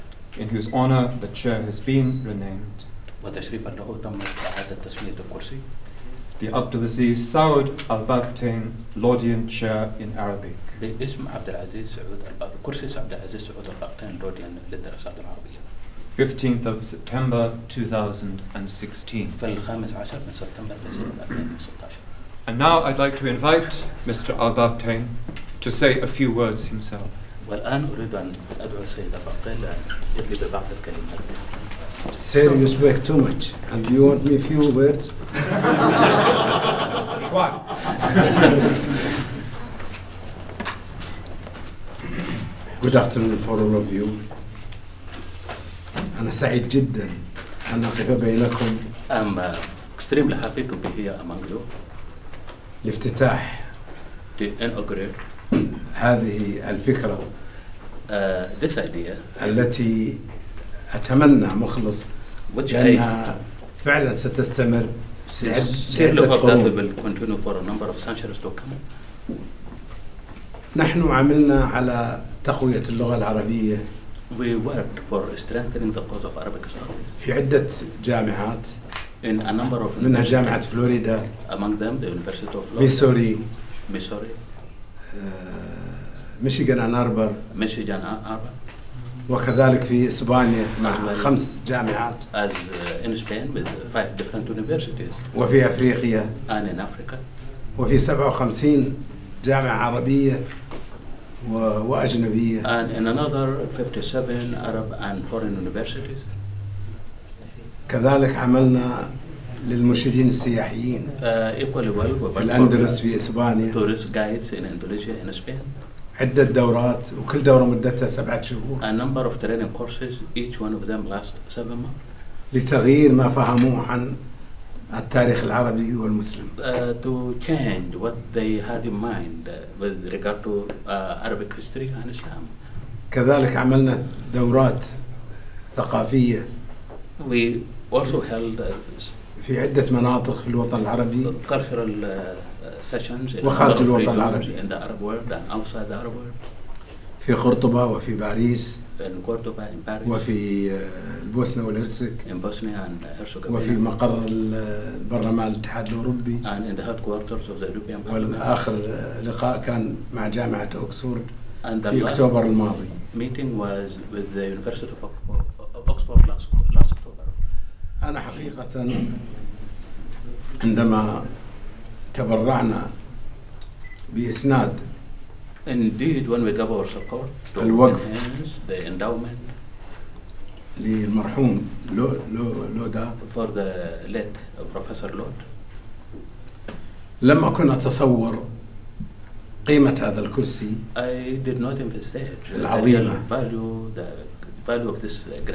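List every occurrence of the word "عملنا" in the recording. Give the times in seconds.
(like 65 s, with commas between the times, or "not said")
71 s, 108 s, 133 s.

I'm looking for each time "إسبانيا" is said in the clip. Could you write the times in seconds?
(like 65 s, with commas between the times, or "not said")
90 s, 113 s.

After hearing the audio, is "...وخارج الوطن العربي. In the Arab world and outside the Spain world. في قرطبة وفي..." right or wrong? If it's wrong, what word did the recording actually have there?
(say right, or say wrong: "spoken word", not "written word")
wrong: "Arab", not "Spain".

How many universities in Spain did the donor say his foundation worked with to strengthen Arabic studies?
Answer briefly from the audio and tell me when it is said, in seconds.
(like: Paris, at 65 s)
5, at 93 s.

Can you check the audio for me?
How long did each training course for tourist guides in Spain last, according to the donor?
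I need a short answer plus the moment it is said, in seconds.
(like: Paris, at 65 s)
7 months, at 121 s.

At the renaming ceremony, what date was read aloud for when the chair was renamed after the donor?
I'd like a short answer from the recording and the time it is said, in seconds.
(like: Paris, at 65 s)
15 September 2016, at 16 s.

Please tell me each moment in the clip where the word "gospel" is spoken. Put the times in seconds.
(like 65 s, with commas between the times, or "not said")
not said.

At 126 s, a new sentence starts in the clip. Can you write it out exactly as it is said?
Uh, to change what they had in mind with regard to uh, Arabic history and Islam.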